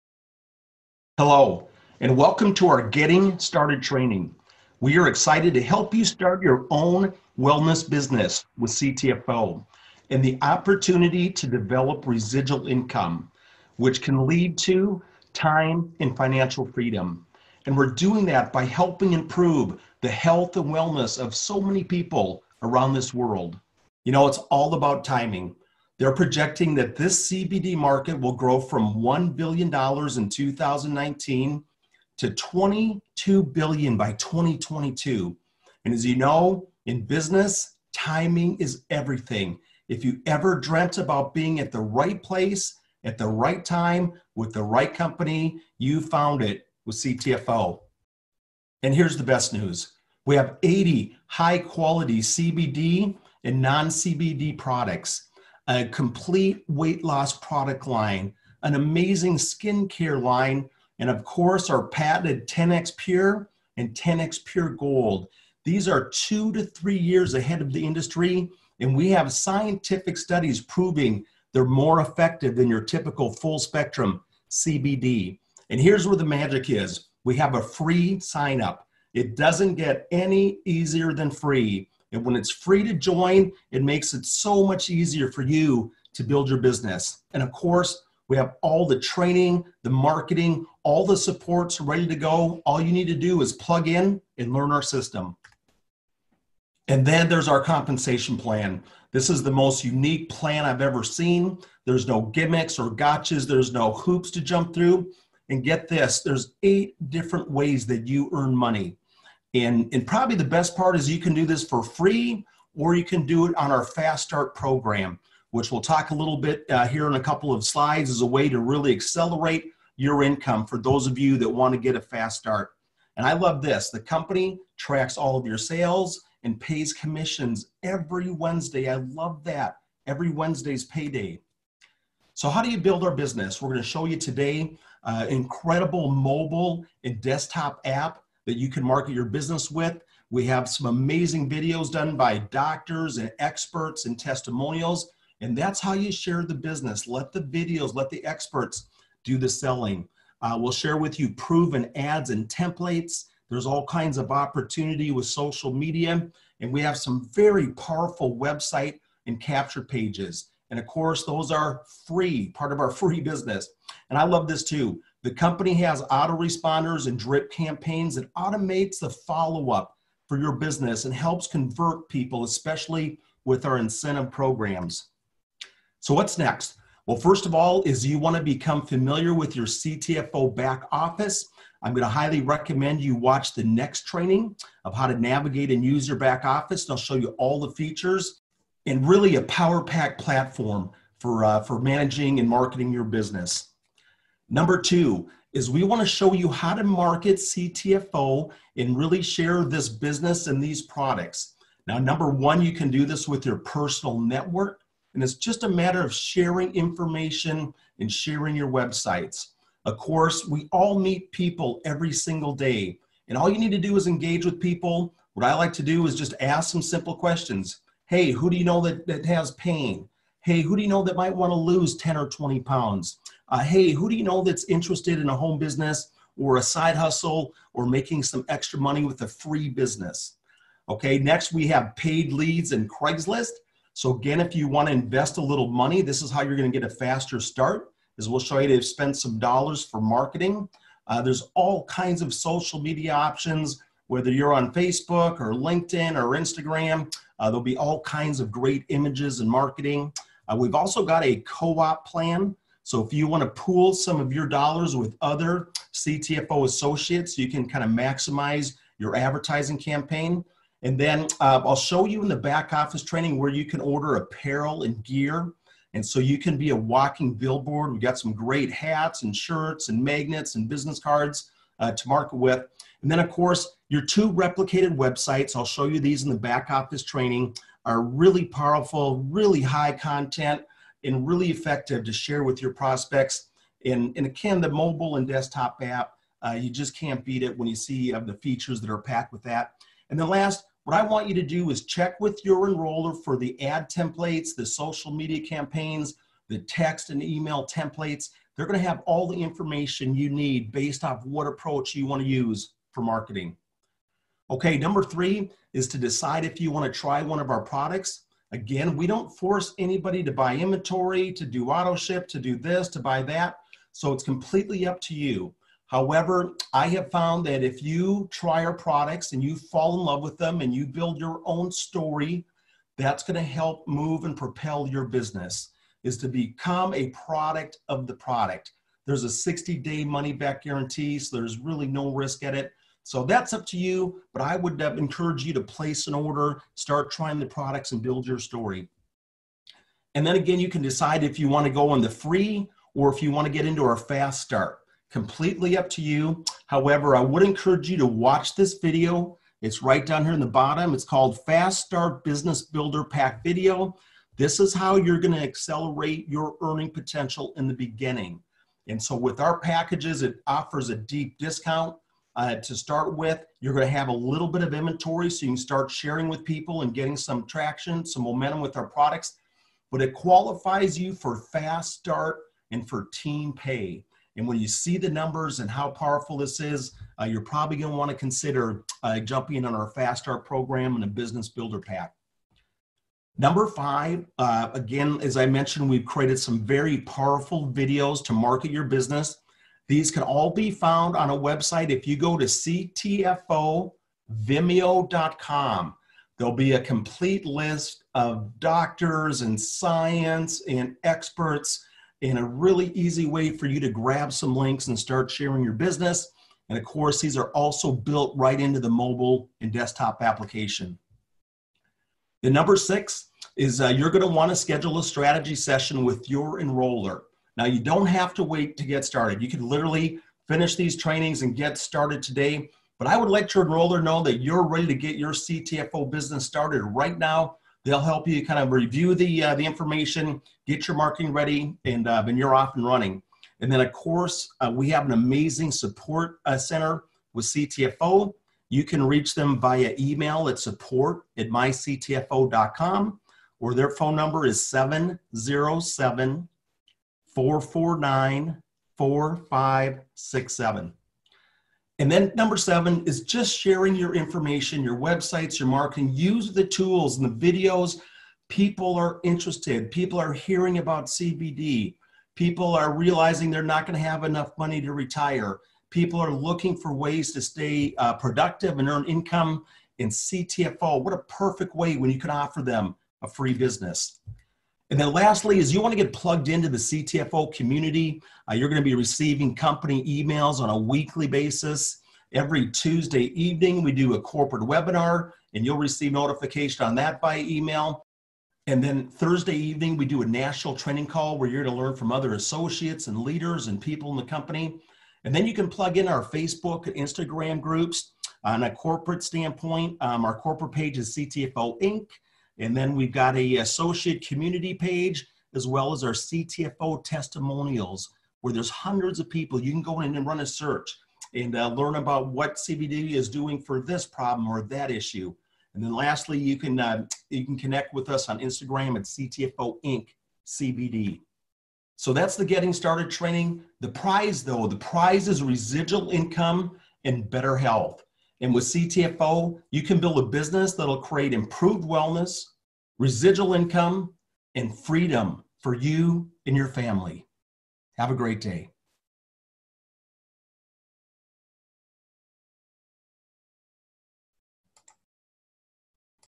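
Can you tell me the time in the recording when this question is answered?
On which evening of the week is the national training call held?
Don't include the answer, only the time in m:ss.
8:09.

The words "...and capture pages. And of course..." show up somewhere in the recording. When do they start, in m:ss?
2:39.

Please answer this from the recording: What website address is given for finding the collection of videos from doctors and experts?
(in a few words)
ctfovimeo.com.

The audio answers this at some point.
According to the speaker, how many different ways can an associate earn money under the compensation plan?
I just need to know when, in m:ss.
1:46.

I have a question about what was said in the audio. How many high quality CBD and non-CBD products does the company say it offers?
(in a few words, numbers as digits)
80.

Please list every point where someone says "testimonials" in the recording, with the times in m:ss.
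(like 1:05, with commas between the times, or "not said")
2:24, 8:27.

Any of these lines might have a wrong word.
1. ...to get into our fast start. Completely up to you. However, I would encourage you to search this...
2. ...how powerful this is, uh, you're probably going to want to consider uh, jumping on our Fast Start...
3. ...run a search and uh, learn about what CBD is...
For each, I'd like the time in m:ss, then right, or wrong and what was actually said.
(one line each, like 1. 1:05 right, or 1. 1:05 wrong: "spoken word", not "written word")
1. 5:43 wrong: "watch", not "search"
2. 6:15 right
3. 8:30 right.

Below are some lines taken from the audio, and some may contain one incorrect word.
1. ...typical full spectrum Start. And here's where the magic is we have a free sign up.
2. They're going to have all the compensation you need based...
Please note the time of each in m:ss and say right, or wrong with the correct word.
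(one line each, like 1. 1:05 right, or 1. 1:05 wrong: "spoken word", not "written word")
1. 1:12 wrong: "CBD", not "Start"
2. 4:58 wrong: "information", not "compensation".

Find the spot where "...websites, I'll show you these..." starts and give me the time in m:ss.
4:34.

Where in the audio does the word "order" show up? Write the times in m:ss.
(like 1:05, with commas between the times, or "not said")
4:23, 5:36.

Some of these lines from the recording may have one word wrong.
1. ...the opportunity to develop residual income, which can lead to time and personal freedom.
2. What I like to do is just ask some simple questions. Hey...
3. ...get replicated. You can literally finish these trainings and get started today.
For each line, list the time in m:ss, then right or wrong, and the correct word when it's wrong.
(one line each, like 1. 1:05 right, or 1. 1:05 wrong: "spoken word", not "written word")
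1. 0:10 wrong: "financial", not "personal"
2. 3:35 right
3. 6:58 wrong: "started", not "replicated".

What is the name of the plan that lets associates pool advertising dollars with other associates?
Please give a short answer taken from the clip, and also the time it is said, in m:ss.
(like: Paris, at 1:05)
co-op plan, at 4:11.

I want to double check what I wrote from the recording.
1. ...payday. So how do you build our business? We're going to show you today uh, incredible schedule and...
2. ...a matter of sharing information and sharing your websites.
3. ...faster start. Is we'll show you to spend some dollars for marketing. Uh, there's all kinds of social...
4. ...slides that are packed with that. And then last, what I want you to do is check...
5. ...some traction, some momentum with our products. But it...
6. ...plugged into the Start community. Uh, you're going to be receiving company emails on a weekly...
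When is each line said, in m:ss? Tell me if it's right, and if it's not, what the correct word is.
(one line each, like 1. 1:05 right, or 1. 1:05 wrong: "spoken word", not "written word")
1. 2:10 wrong: "mobile", not "schedule"
2. 3:25 right
3. 3:56 right
4. 4:48 wrong: "features", not "slides"
5. 6:07 right
6. 7:56 wrong: "CTFO", not "Start".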